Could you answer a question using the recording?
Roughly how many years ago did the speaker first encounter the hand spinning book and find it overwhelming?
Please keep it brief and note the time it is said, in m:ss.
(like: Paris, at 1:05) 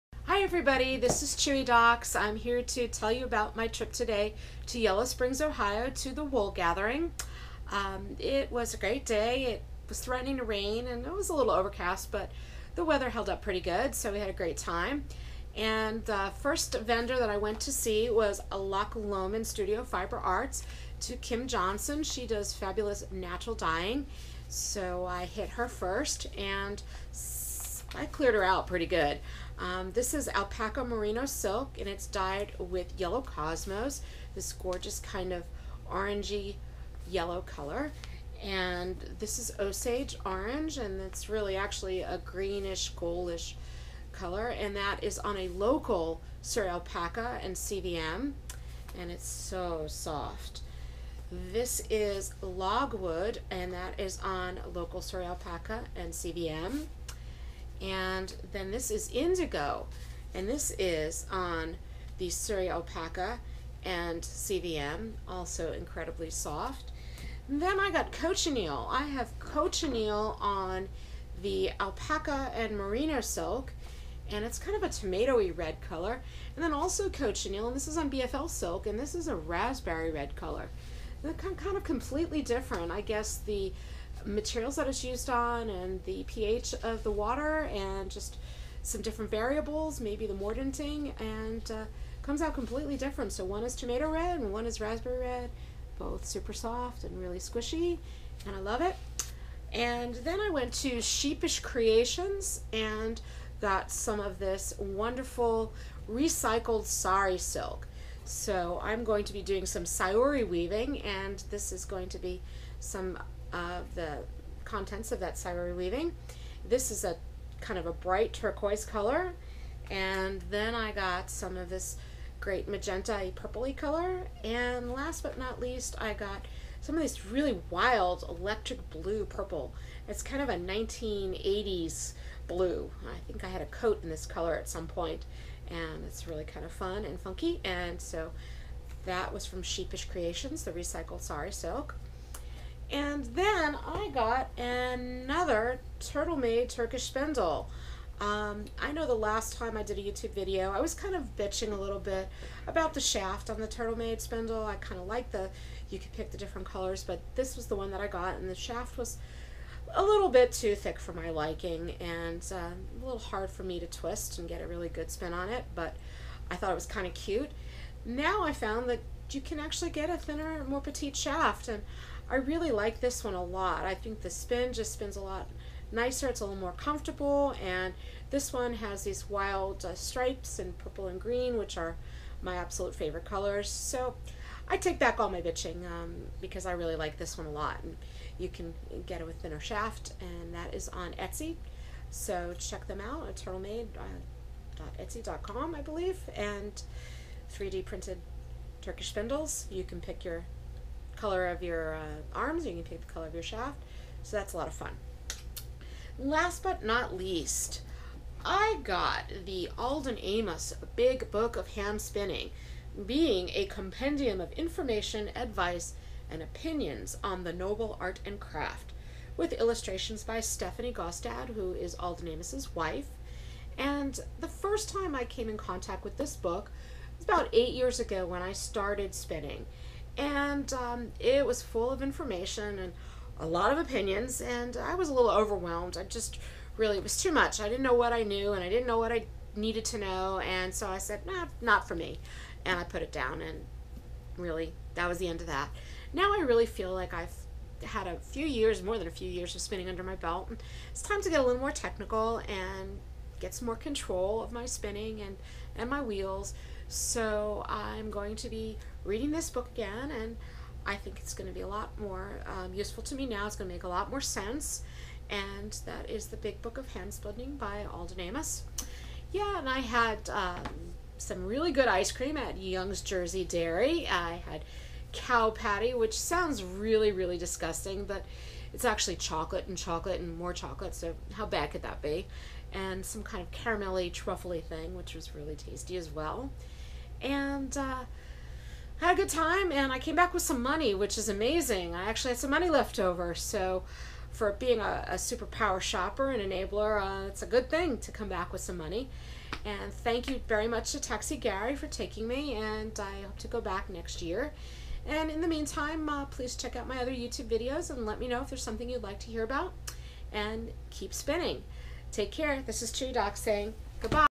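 8, at 3:47.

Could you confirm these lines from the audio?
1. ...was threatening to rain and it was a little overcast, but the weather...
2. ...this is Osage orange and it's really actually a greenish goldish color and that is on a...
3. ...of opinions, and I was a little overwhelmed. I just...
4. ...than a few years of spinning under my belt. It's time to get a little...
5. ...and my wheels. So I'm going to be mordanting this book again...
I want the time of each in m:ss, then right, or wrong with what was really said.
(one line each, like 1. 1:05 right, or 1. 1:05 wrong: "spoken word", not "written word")
1. 0:09 right
2. 0:39 right
3. 3:53 right
4. 4:08 right
5. 4:15 wrong: "reading", not "mordanting".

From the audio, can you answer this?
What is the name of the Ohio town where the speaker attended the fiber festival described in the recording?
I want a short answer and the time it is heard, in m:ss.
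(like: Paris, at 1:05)
Yellow Springs, at 0:04.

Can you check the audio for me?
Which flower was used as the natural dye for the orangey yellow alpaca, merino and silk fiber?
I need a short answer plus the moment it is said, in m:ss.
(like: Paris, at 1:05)
yellow cosmos, at 0:32.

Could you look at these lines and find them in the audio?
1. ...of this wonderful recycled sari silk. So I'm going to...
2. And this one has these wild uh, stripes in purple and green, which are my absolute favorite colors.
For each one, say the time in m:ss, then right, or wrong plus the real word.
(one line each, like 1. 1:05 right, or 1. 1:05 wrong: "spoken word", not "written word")
1. 1:44 right
2. 2:57 right.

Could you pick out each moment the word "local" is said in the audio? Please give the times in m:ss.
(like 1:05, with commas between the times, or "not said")
0:45, 0:54.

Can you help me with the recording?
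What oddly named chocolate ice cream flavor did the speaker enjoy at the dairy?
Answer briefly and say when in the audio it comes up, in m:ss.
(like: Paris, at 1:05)
cow patty, at 4:35.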